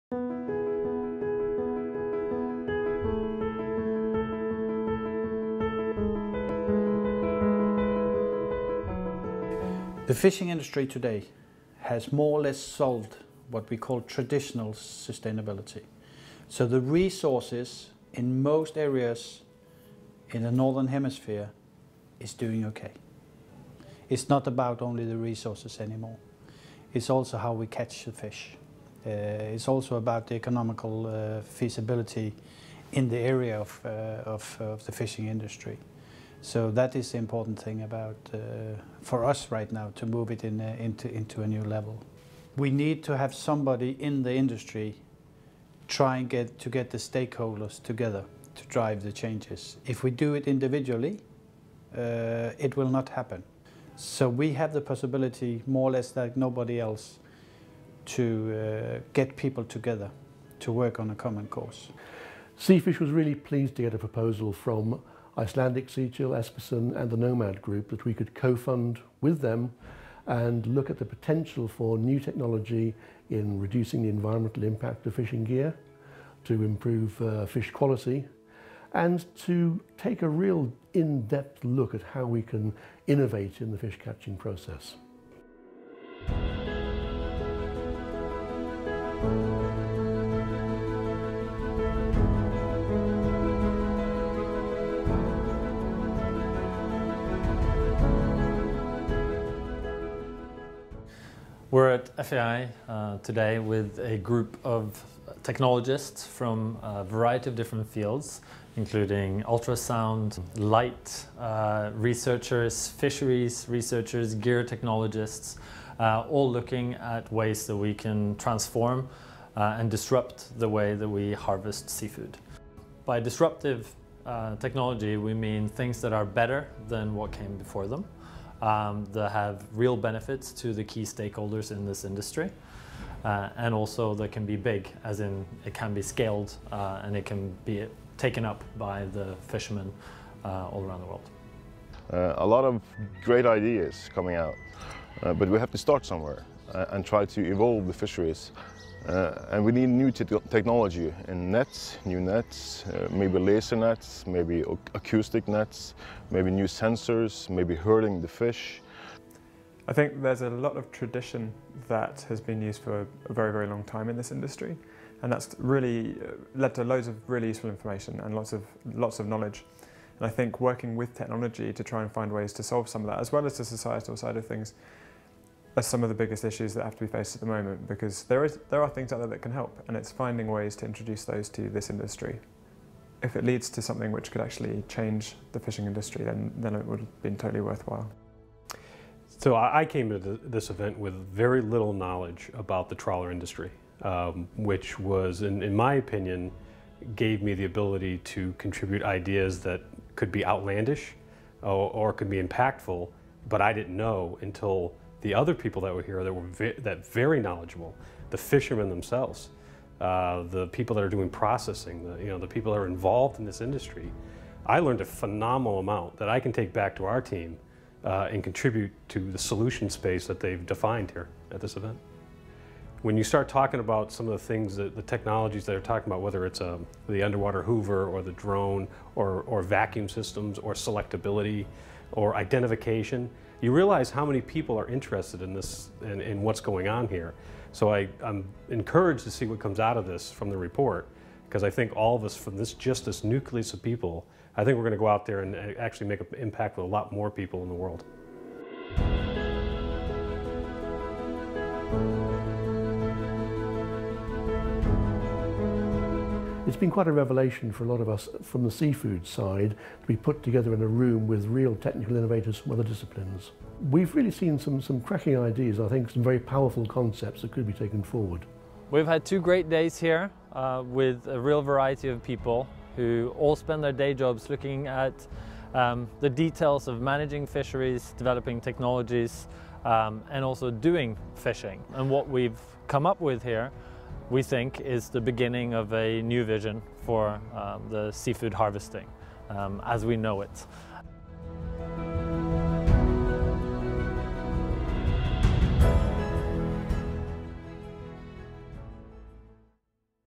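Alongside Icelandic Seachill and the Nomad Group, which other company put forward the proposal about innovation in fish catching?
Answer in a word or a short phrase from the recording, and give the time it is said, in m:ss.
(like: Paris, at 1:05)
Espersen, at 1:06.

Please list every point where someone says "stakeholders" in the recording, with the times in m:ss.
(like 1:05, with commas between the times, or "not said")
0:46, 2:11.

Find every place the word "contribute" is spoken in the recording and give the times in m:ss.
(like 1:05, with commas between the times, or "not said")
3:18, 3:38.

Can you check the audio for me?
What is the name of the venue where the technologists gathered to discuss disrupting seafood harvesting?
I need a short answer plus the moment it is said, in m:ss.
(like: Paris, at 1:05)
FAI, at 1:42.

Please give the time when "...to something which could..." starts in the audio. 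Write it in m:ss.
3:03.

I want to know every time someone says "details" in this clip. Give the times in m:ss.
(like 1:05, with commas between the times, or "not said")
4:36.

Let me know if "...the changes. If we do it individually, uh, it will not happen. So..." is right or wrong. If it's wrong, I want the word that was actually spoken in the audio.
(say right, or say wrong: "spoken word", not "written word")
right.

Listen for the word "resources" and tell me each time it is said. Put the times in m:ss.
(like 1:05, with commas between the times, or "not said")
0:16, 0:25.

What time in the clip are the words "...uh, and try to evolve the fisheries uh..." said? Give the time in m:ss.
2:26.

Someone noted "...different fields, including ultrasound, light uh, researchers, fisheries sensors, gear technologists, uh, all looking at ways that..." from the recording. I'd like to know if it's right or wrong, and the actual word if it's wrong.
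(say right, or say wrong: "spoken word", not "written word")
wrong: "researchers", not "sensors".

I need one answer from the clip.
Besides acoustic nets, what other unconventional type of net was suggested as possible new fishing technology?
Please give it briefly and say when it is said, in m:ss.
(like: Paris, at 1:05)
Laser nets, at 2:33.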